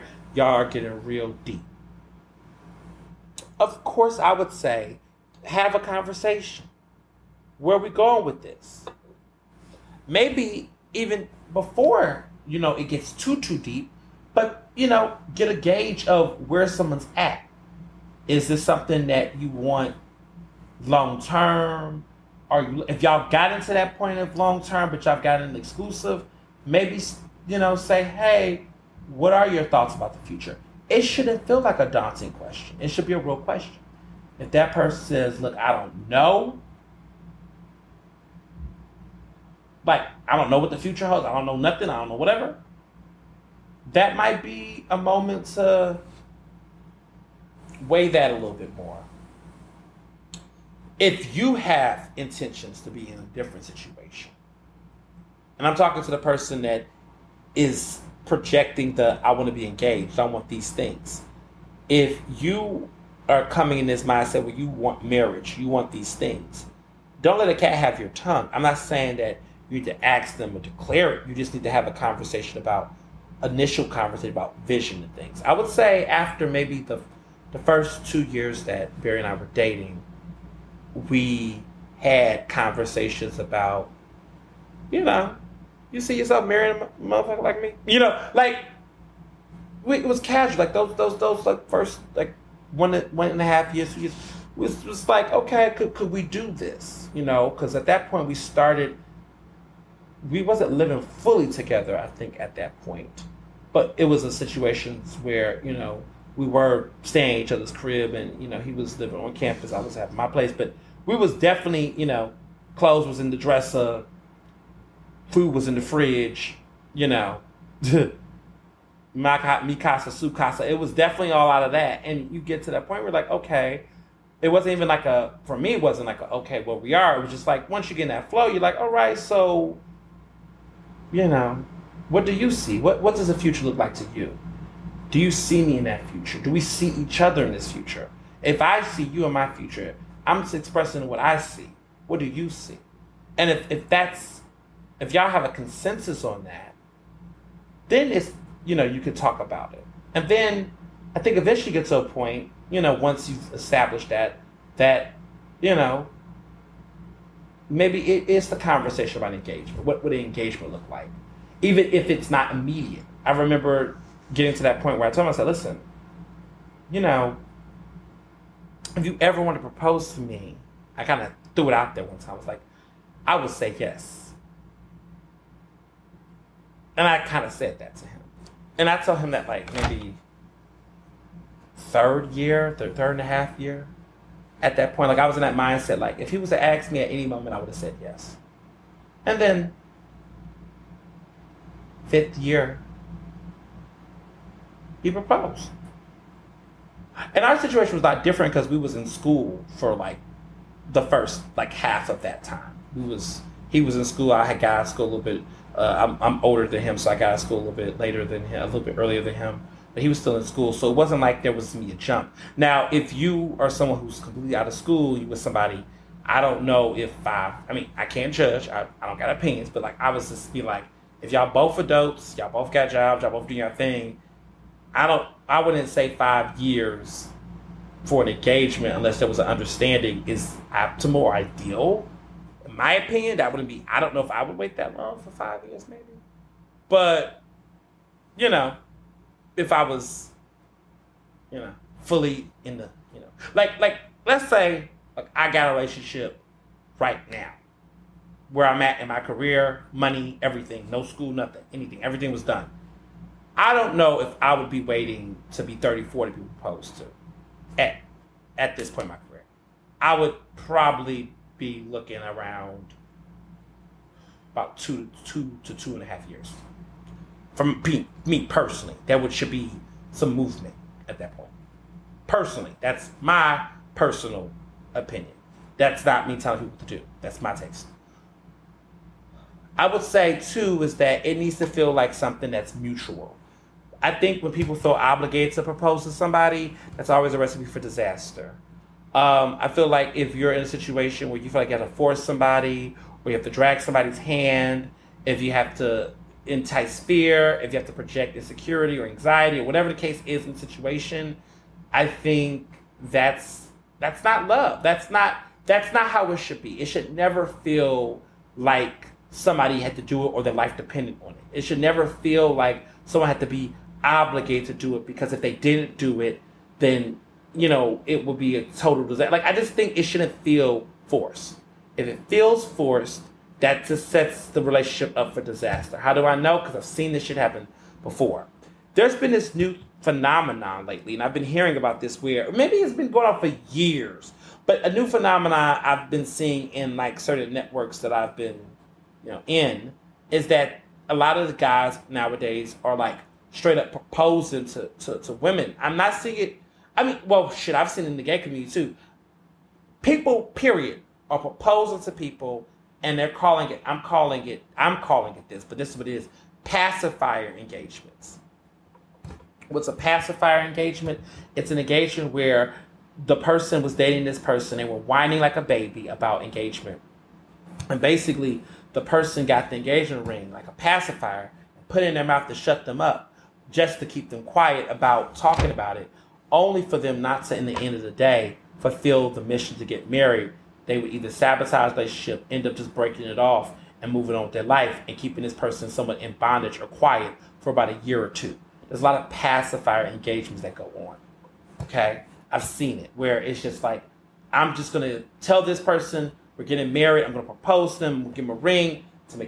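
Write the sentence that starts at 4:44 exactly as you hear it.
I think when people feel obligated to propose to somebody, that's always a recipe for disaster.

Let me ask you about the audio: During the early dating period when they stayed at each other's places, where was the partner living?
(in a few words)
on campus.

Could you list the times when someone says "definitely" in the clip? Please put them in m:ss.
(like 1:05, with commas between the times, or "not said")
1:51, 2:00.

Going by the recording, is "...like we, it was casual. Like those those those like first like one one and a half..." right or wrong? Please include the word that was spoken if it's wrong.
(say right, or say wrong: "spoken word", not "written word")
right.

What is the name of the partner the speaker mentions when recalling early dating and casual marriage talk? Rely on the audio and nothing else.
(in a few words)
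Barry.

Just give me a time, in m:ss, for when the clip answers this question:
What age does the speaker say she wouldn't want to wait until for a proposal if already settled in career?
4:15.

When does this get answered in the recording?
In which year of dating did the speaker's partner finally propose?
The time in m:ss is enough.
3:12.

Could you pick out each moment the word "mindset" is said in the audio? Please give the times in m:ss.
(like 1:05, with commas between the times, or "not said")
1:04, 3:05.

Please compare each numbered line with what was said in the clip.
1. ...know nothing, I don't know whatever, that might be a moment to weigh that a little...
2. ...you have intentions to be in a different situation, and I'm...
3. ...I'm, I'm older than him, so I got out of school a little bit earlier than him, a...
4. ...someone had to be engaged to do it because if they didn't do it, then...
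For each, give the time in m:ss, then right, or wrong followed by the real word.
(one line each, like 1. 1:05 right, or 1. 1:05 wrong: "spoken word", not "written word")
1. 0:41 right
2. 0:51 right
3. 3:25 wrong: "later", not "earlier"
4. 5:13 wrong: "obligated", not "engaged".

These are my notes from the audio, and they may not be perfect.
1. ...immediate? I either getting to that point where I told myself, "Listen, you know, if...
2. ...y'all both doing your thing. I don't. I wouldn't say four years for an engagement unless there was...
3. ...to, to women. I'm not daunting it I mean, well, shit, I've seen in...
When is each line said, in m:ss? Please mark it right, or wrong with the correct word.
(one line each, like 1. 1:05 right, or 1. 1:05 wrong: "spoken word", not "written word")
1. 2:42 wrong: "remember", not "either"
2. 3:43 wrong: "five", not "four"
3. 5:44 wrong: "seeing", not "daunting".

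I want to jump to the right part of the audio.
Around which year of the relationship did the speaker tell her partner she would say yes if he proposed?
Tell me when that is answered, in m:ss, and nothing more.
3:01.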